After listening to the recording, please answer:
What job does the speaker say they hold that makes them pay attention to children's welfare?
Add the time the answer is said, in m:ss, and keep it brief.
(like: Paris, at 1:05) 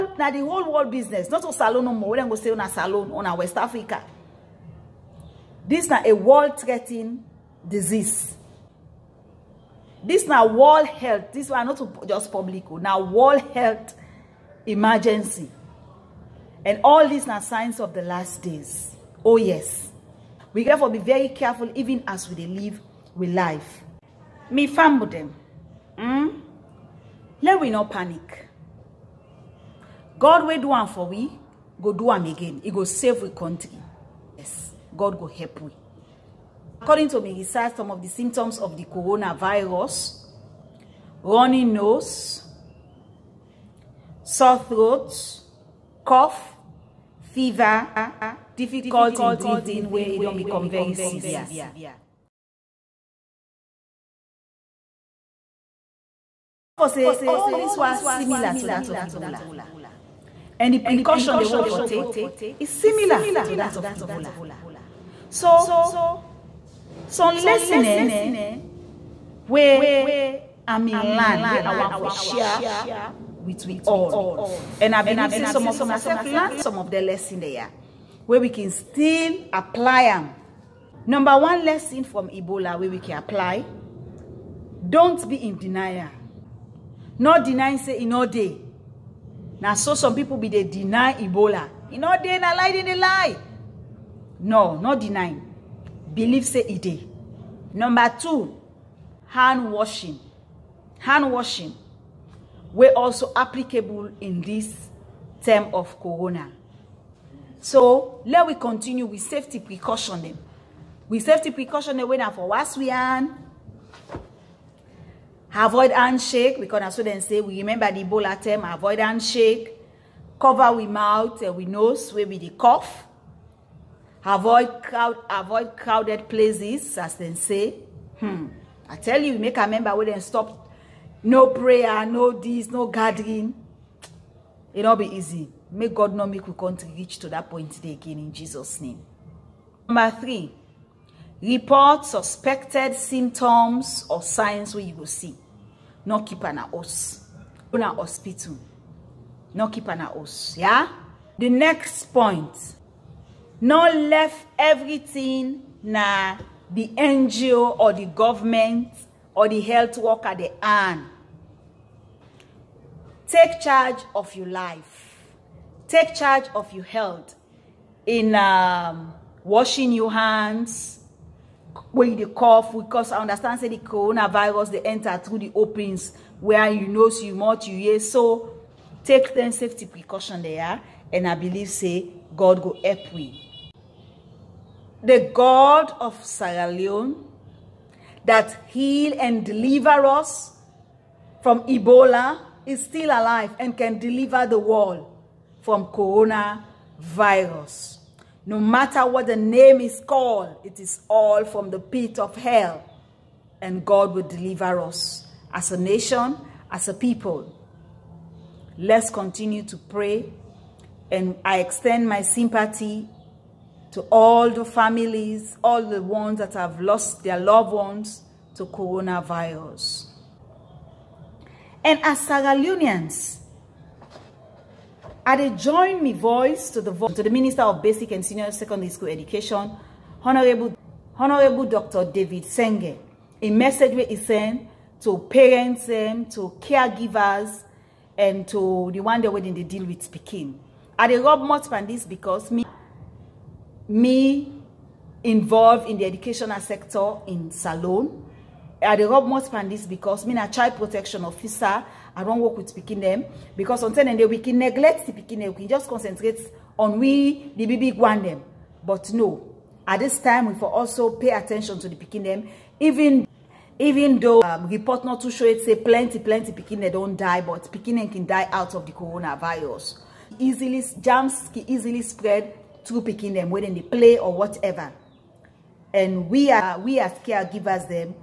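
Child protection officer, at 4:10.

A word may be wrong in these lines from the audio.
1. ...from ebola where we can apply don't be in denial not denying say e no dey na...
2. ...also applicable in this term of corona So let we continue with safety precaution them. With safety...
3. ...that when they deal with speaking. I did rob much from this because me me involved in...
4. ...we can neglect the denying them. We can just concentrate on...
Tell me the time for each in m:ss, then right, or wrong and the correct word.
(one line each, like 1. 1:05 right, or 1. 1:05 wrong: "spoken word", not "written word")
1. 1:22 right
2. 1:42 right
3. 3:59 right
4. 4:14 wrong: "picking", not "denying".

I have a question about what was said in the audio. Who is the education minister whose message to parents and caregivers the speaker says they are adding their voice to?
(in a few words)
Dr. David Senge.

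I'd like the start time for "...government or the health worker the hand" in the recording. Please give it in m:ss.
2:38.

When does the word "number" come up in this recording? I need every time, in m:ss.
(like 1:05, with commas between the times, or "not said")
1:21, 1:37, 2:19.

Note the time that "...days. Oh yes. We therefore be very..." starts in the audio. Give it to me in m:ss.
0:18.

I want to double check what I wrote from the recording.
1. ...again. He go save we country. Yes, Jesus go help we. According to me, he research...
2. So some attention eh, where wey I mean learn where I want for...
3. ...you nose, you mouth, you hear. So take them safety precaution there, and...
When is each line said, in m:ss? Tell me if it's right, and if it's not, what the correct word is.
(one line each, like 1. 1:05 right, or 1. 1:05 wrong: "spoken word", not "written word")
1. 0:32 wrong: "God", not "Jesus"
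2. 1:05 wrong: "lesson", not "attention"
3. 2:56 right.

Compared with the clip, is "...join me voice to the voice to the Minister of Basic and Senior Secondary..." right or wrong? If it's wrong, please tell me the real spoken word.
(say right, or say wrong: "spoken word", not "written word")
right.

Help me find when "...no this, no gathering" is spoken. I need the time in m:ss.
2:12.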